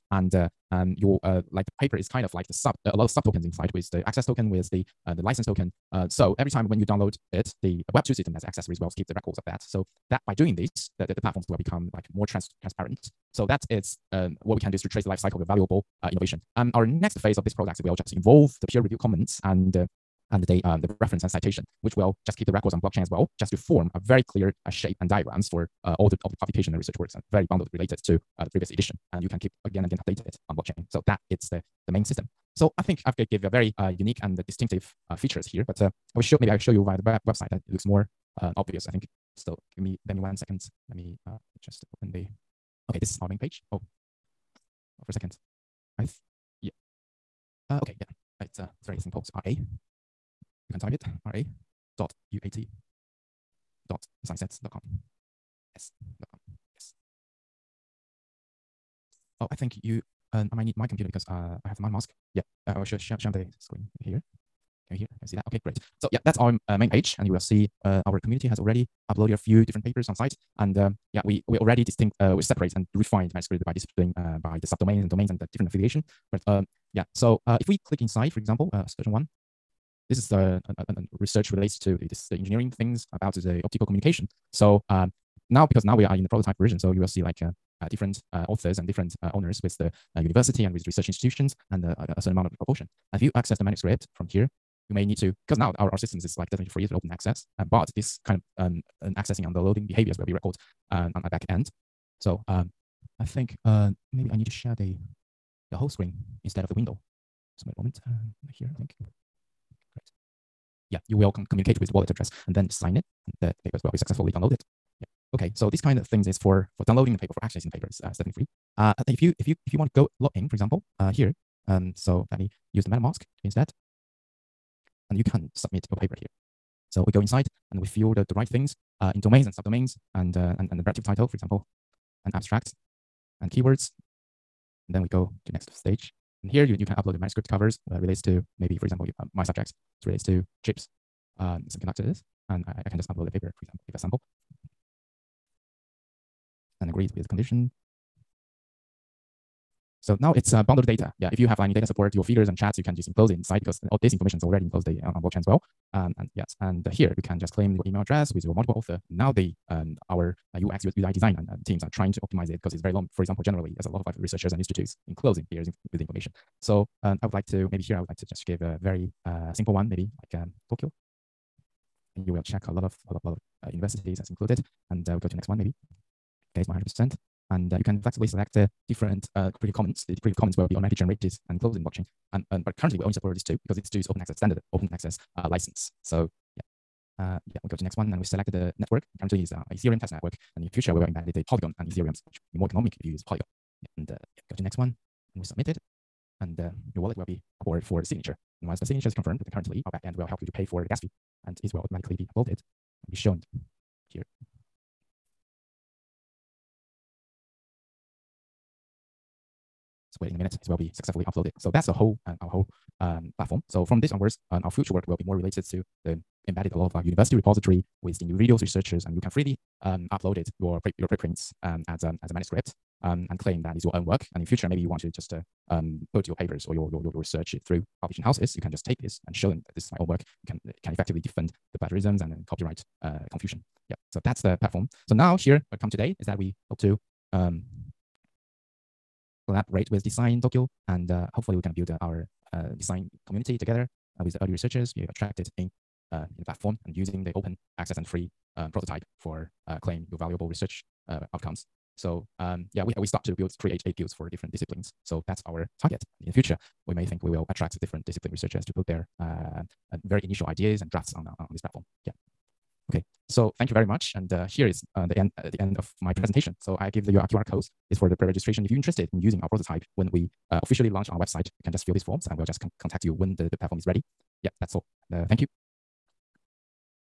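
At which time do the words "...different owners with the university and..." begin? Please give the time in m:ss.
1:28.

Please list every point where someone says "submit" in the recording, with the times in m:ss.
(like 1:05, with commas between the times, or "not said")
2:05, 3:15.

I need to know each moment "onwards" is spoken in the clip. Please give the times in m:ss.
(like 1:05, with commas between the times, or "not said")
3:34.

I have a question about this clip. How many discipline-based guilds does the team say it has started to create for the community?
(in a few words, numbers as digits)
8.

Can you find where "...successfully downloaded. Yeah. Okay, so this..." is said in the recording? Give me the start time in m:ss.
1:53.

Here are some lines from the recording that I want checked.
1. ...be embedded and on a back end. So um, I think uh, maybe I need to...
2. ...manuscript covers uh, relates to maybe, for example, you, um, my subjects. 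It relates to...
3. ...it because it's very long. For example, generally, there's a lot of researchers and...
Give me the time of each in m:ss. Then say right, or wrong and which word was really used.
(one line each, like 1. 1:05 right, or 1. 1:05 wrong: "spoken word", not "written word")
1. 1:40 wrong: "recorded", not "embedded"
2. 2:17 right
3. 2:42 right.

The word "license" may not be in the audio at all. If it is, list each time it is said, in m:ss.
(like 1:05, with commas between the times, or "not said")
0:05, 3:05.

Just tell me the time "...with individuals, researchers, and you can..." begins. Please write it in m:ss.
3:38.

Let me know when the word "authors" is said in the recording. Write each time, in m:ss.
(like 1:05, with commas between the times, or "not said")
1:28, 2:38.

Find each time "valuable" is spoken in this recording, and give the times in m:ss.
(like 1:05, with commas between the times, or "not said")
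0:15, 4:10.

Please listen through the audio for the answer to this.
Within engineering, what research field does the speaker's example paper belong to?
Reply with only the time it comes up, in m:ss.
1:23.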